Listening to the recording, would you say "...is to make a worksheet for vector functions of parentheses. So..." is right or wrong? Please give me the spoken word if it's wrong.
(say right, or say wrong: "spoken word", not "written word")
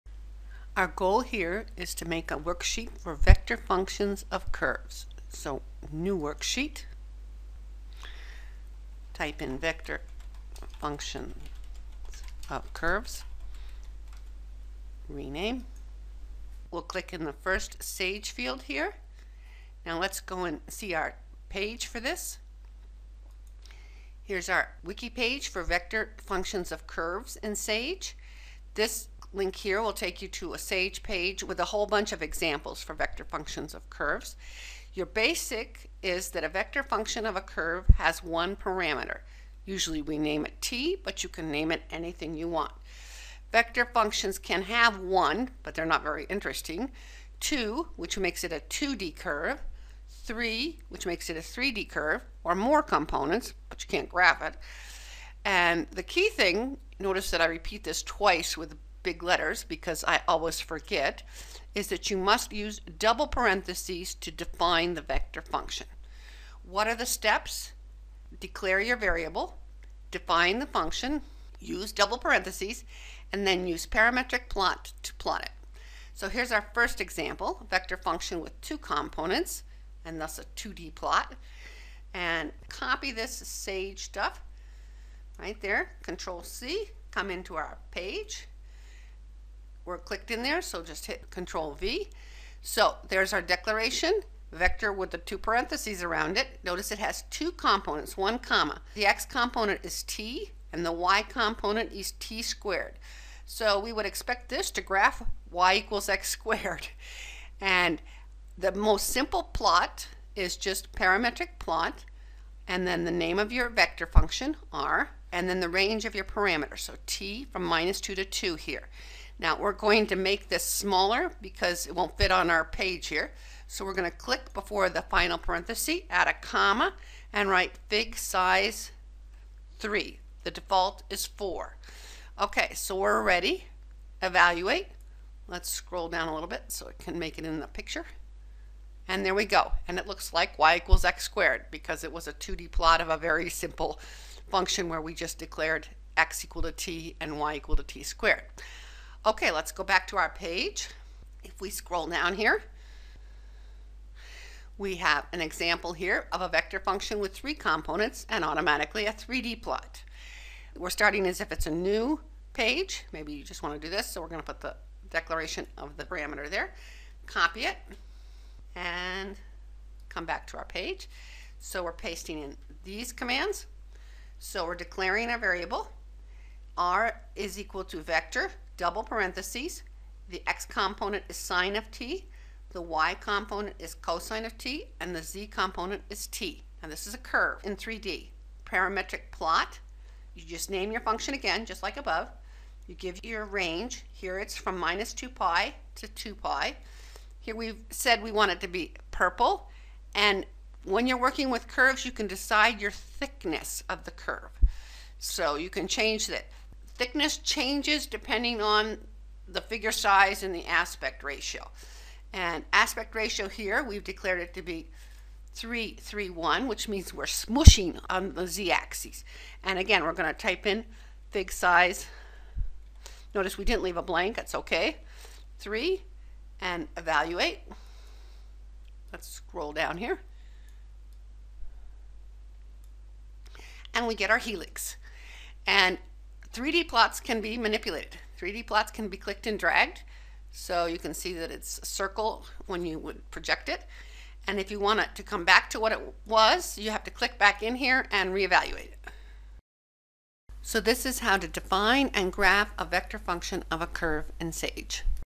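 wrong: "curves", not "parentheses".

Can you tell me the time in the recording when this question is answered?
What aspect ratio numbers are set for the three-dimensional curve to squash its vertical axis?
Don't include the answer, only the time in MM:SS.
03:35.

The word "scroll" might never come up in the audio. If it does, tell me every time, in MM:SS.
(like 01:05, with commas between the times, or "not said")
02:15, 02:31, 03:49.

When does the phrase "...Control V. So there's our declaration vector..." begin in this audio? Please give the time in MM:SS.
01:31.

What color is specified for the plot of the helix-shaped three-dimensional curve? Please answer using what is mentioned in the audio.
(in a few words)
purple.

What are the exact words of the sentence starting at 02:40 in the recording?
We're starting as if it's a new page.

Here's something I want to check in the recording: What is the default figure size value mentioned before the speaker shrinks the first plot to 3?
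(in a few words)
4.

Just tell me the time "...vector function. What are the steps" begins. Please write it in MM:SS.
01:05.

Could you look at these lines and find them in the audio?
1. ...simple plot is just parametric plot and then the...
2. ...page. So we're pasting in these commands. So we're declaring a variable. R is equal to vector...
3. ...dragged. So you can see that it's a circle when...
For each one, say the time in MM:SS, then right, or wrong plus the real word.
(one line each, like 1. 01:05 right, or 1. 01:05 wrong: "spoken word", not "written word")
1. 01:49 right
2. 02:50 right
3. 03:59 right.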